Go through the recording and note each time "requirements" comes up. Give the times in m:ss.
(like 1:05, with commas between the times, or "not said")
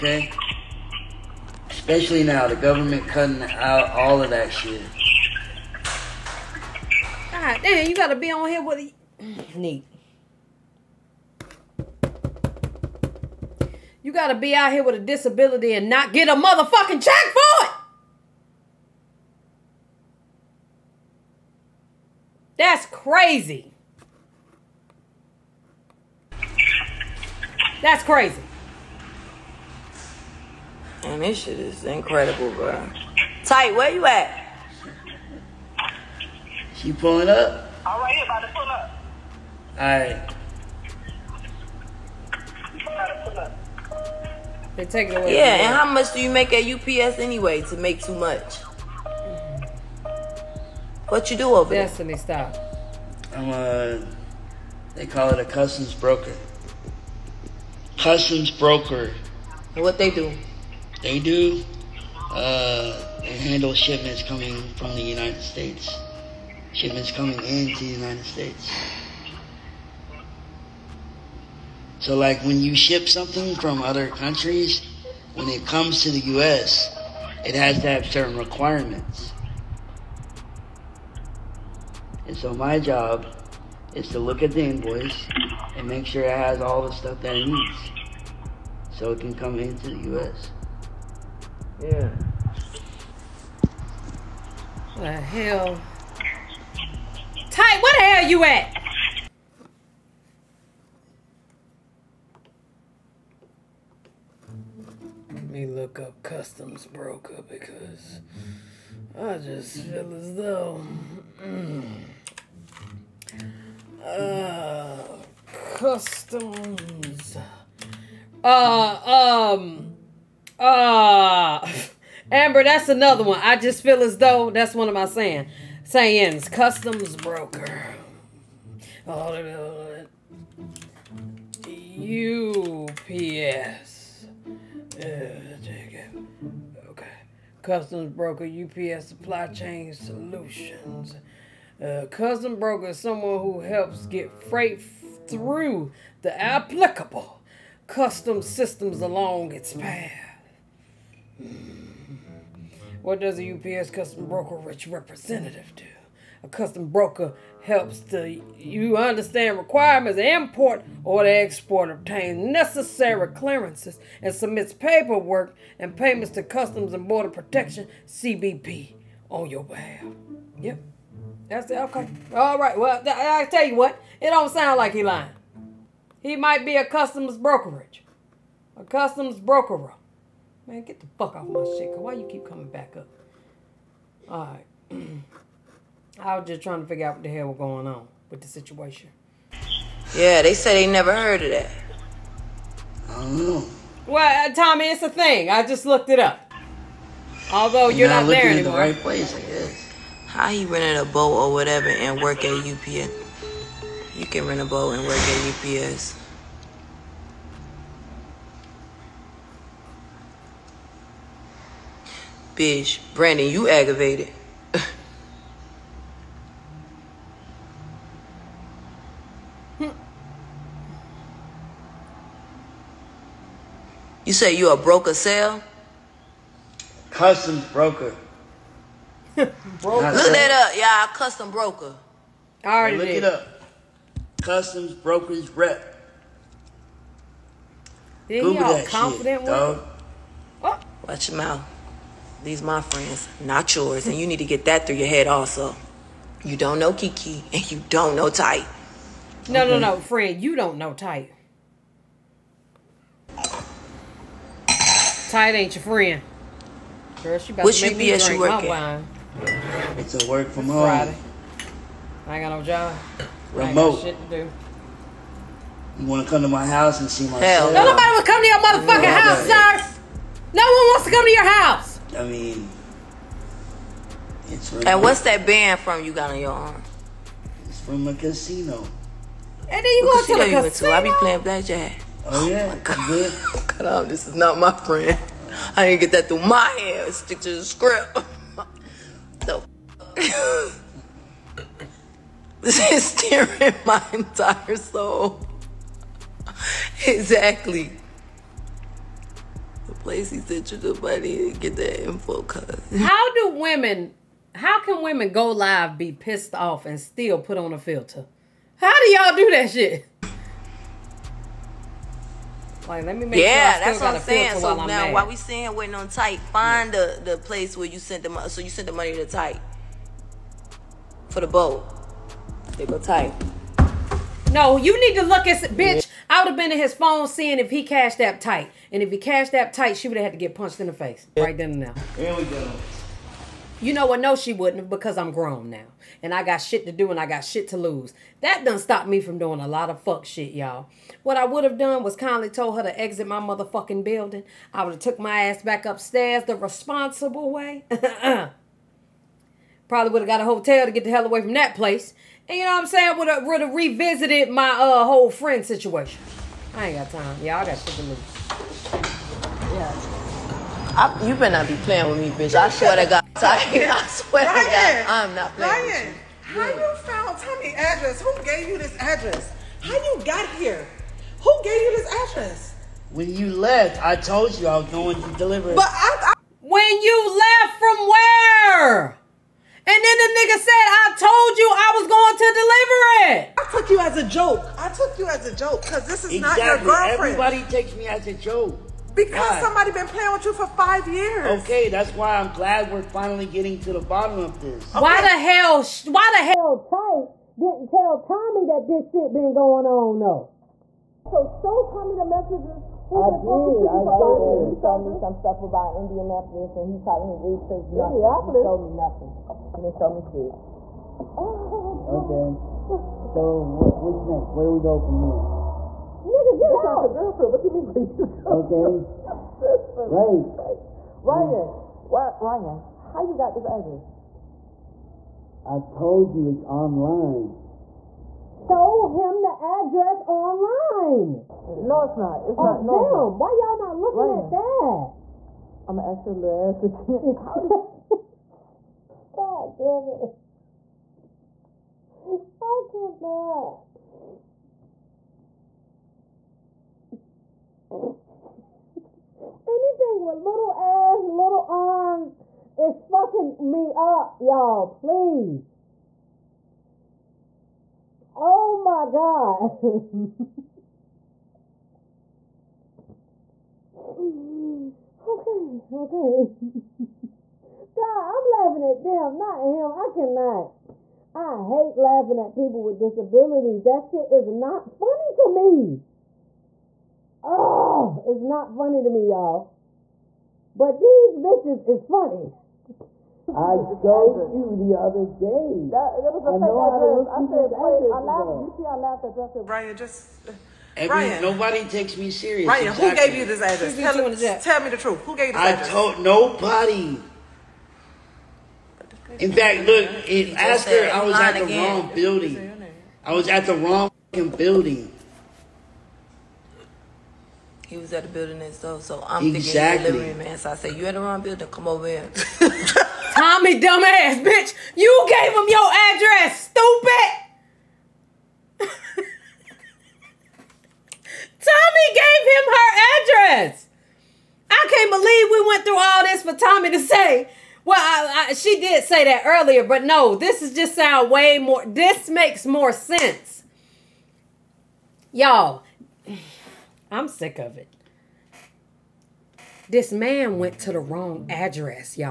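1:18, 2:39.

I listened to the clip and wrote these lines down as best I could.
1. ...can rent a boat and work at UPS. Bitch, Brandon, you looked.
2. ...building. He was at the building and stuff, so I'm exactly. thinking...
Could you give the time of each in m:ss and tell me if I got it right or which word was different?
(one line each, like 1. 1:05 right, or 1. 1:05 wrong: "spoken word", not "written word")
1. 3:24 wrong: "aggravated", not "looked"
2. 8:24 right.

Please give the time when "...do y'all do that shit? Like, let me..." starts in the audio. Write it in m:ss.
5:09.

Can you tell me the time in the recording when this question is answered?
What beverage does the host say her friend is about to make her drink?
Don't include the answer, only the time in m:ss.
4:18.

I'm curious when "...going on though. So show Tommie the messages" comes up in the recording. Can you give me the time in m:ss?
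6:39.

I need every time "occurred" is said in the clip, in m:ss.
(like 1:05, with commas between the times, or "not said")
not said.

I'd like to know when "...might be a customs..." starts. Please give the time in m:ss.
2:56.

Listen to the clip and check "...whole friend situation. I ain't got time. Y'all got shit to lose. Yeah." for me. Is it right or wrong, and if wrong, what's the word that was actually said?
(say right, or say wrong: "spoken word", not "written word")
right.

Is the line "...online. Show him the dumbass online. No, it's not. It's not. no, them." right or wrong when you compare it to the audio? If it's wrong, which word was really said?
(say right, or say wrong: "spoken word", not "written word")
wrong: "address", not "dumbass".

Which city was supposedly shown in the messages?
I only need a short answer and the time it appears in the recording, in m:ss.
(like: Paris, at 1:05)
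Indianapolis, at 6:46.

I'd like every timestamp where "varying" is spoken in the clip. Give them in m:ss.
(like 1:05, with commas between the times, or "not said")
not said.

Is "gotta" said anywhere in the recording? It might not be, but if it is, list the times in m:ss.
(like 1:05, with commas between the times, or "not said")
0:07, 0:14.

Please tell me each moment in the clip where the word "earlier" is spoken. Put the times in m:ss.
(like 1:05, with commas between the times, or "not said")
8:49.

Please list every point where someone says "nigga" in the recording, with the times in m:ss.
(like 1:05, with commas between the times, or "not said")
6:20, 6:56.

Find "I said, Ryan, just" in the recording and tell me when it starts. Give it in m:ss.
8:09.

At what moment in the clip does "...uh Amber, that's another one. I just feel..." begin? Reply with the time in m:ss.
2:00.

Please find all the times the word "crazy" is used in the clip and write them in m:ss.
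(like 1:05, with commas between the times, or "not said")
0:22, 0:28.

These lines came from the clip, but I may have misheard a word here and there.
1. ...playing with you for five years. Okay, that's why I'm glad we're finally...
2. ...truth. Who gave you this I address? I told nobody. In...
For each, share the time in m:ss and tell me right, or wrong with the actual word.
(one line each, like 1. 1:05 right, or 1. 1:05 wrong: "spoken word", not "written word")
1. 6:30 right
2. 8:14 right.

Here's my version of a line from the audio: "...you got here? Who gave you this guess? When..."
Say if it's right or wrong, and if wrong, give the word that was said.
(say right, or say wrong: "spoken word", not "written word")
wrong: "address", not "guess".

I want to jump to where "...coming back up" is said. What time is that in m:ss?
3:02.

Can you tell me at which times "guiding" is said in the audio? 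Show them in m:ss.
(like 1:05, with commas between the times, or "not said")
not said.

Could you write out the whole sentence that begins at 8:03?
I showed you the other day.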